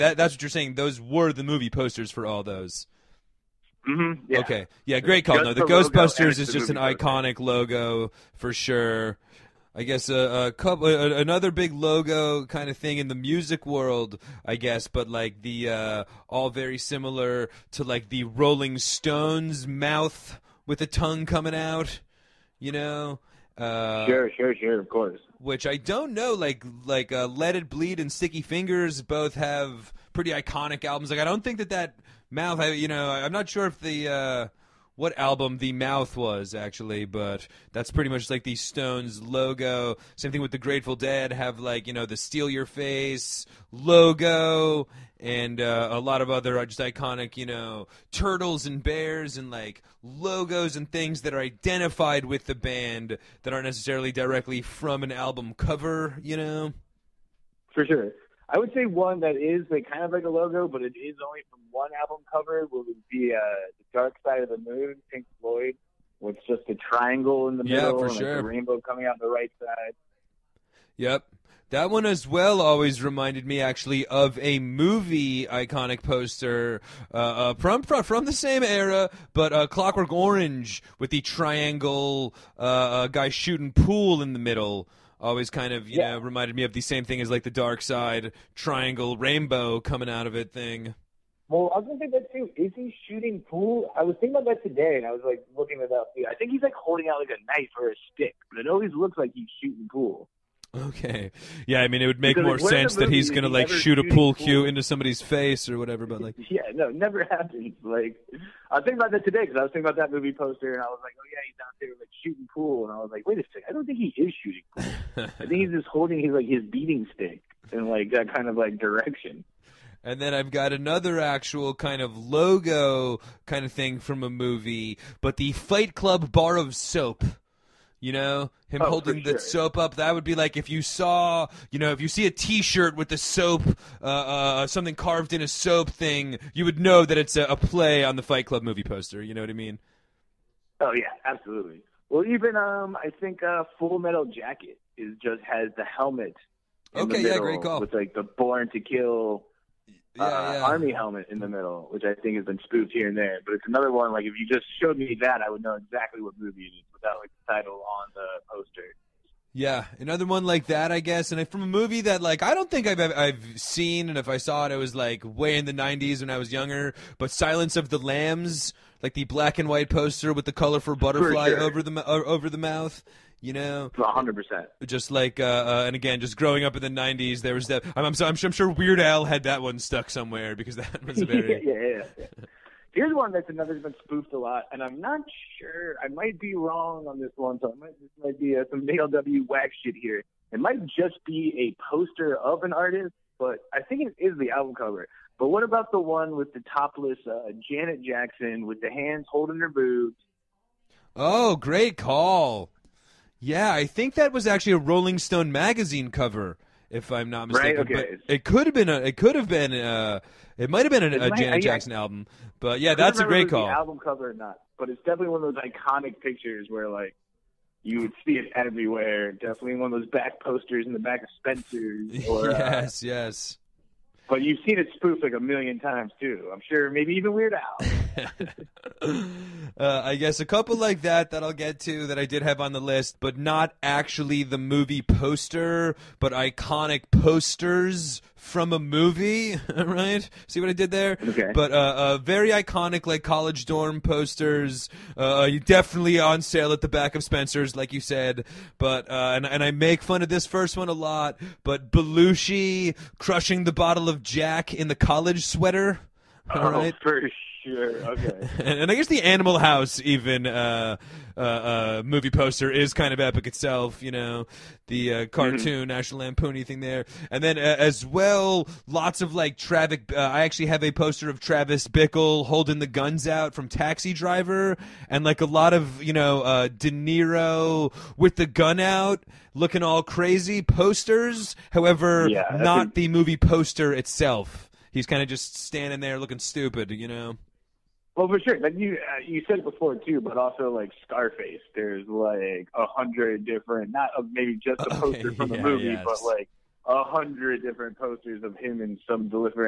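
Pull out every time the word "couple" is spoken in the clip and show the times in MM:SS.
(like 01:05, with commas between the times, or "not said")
00:10, 03:50.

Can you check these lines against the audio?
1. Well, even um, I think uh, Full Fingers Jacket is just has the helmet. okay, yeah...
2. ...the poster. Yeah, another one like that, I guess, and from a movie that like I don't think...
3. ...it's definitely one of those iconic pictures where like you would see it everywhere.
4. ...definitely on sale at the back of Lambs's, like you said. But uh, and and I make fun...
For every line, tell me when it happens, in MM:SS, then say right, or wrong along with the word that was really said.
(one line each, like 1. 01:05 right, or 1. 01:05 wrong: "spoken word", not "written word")
1. 02:22 wrong: "Metal", not "Fingers"
2. 02:38 right
3. 03:34 right
4. 04:05 wrong: "Spencer", not "Lambs".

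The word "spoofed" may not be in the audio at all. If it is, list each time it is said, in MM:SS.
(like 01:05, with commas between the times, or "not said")
02:32, 03:04, 03:44.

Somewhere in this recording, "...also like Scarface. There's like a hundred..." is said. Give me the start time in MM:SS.
04:50.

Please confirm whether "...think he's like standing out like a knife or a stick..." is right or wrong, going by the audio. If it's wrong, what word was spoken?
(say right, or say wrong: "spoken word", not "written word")
wrong: "holding", not "standing".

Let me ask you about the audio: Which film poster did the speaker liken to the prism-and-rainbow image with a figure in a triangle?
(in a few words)
Clockwork Orange.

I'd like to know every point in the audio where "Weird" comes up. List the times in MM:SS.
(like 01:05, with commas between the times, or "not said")
02:58, 03:47.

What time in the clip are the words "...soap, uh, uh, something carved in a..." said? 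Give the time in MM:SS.
02:13.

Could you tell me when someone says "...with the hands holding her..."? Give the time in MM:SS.
03:18.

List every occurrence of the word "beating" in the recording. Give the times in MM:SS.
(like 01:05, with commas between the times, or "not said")
01:56.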